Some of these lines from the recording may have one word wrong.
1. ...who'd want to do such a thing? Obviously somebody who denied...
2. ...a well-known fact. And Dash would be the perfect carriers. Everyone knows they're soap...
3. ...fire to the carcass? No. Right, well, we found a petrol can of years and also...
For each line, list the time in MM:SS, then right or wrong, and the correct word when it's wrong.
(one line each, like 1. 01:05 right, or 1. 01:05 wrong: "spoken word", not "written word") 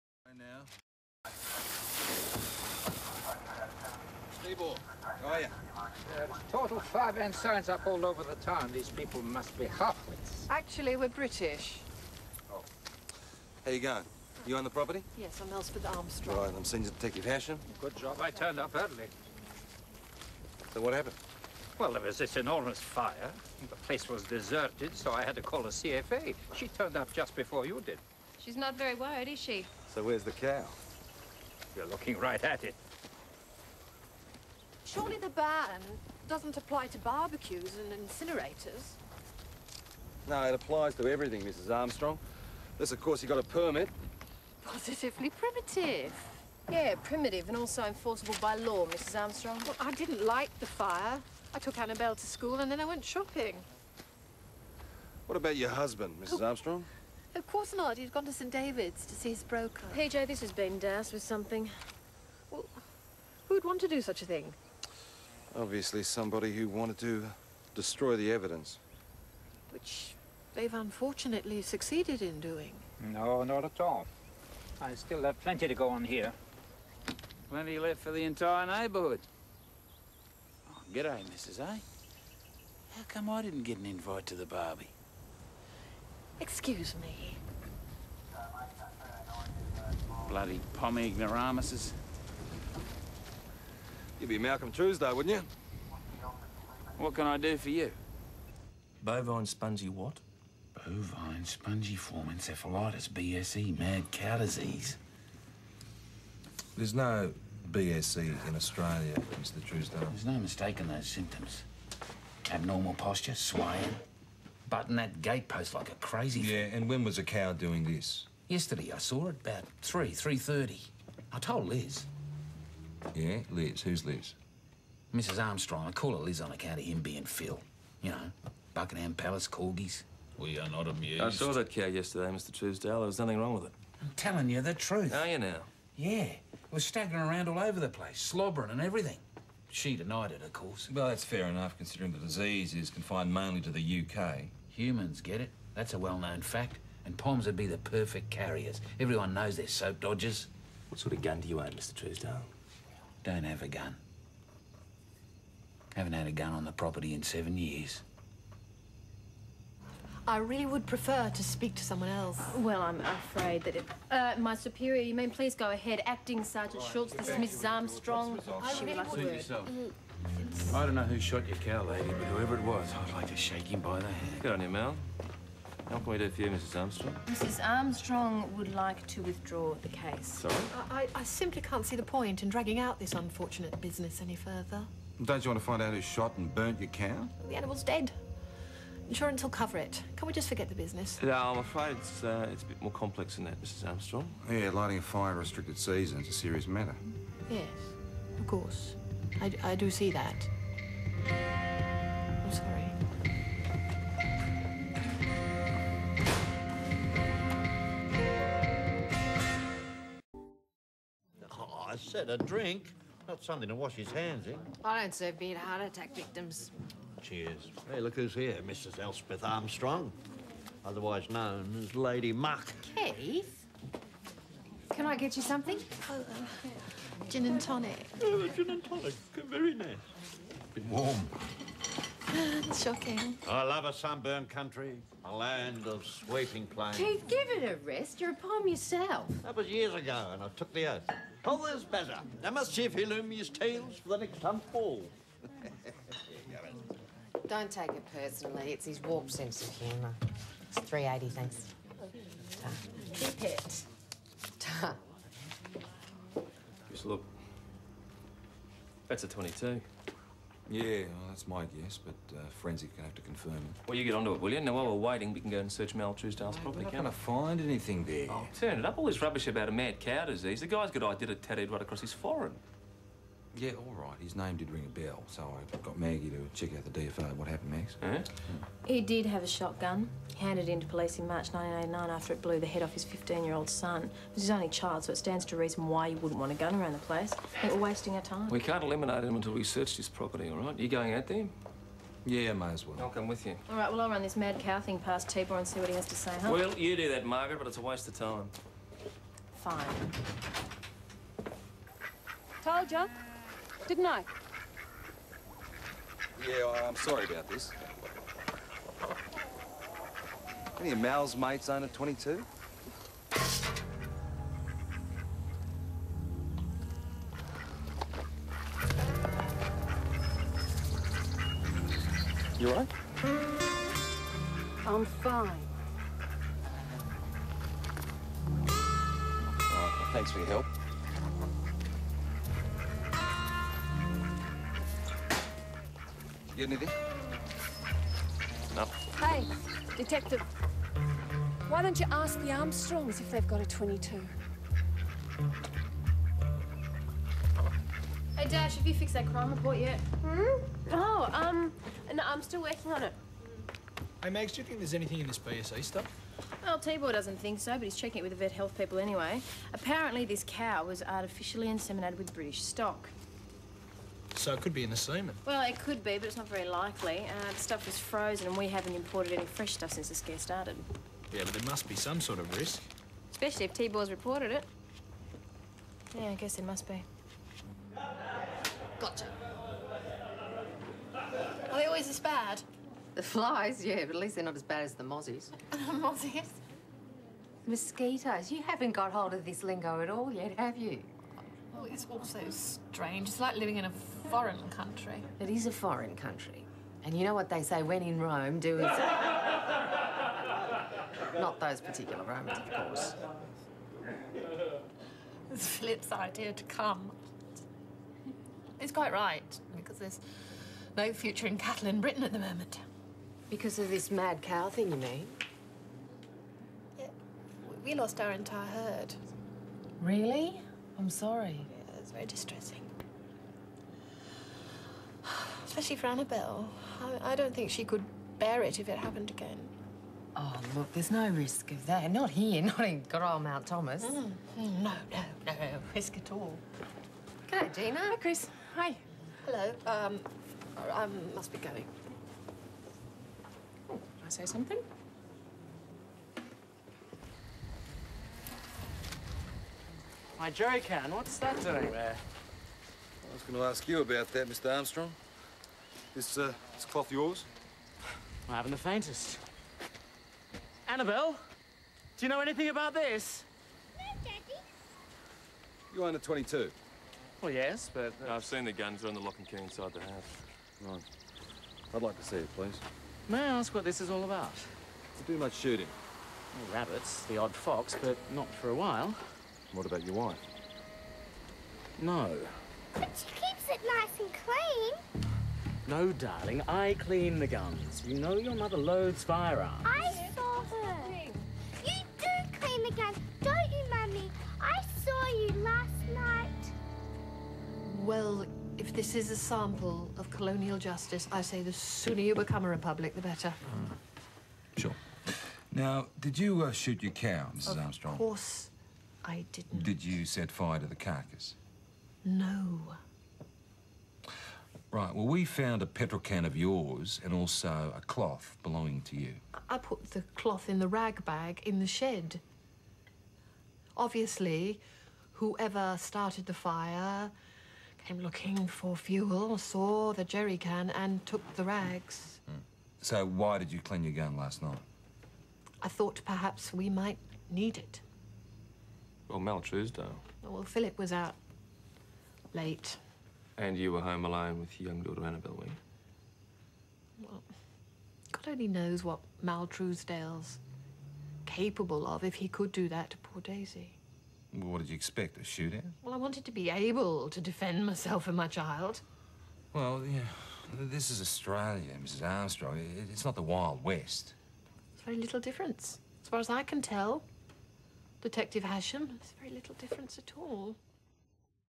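1. 01:03 wrong: "wanted", not "denied"
2. 02:25 wrong: "Poms", not "Dash"
3. 08:30 wrong: "yours", not "years".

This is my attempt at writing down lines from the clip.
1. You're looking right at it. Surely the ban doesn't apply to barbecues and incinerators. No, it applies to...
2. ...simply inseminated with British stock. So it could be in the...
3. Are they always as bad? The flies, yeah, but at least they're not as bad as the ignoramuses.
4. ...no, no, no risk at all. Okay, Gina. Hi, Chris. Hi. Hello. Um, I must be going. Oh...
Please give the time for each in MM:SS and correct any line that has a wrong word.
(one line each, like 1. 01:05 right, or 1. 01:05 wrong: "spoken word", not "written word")
1. 00:31 right
2. 06:01 wrong: "artificially", not "simply"
3. 06:21 wrong: "mozzies", not "ignoramuses"
4. 07:14 right.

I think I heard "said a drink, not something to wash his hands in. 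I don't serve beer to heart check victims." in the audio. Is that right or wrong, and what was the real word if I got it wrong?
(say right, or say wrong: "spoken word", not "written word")
wrong: "attack", not "check".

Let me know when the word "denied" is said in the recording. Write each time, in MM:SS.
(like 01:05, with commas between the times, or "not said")
02:19.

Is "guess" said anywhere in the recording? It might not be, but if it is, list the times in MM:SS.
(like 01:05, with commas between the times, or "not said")
04:21, 06:16.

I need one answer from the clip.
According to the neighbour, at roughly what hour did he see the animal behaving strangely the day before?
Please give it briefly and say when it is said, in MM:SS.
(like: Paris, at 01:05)
3 to 3:30, at 01:59.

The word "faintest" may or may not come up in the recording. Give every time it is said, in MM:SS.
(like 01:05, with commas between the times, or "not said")
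07:38.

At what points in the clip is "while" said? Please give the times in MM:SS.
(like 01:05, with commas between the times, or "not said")
04:24, 07:58.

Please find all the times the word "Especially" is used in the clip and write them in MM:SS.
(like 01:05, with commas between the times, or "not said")
06:13, 07:05.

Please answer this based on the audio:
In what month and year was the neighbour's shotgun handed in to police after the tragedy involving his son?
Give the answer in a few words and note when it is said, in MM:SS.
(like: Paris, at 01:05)
March 1989, at 04:41.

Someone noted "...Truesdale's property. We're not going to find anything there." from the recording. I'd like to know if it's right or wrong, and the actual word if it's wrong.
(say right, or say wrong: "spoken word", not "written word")
right.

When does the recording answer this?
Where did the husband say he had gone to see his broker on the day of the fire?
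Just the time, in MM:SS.
00:58.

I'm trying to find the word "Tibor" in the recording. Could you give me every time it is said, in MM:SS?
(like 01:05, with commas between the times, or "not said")
04:55, 05:56, 06:13.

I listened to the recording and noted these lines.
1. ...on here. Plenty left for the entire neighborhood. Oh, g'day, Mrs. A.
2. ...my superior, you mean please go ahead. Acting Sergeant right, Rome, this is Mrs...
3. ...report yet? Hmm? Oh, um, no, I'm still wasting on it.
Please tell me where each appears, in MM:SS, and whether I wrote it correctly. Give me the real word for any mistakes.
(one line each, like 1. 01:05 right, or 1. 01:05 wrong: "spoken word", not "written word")
1. 01:15 right
2. 02:44 wrong: "Schultz", not "Rome"
3. 05:49 wrong: "working", not "wasting".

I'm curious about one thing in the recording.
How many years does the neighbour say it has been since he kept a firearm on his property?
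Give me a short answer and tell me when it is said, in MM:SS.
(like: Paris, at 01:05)
7, at 02:37.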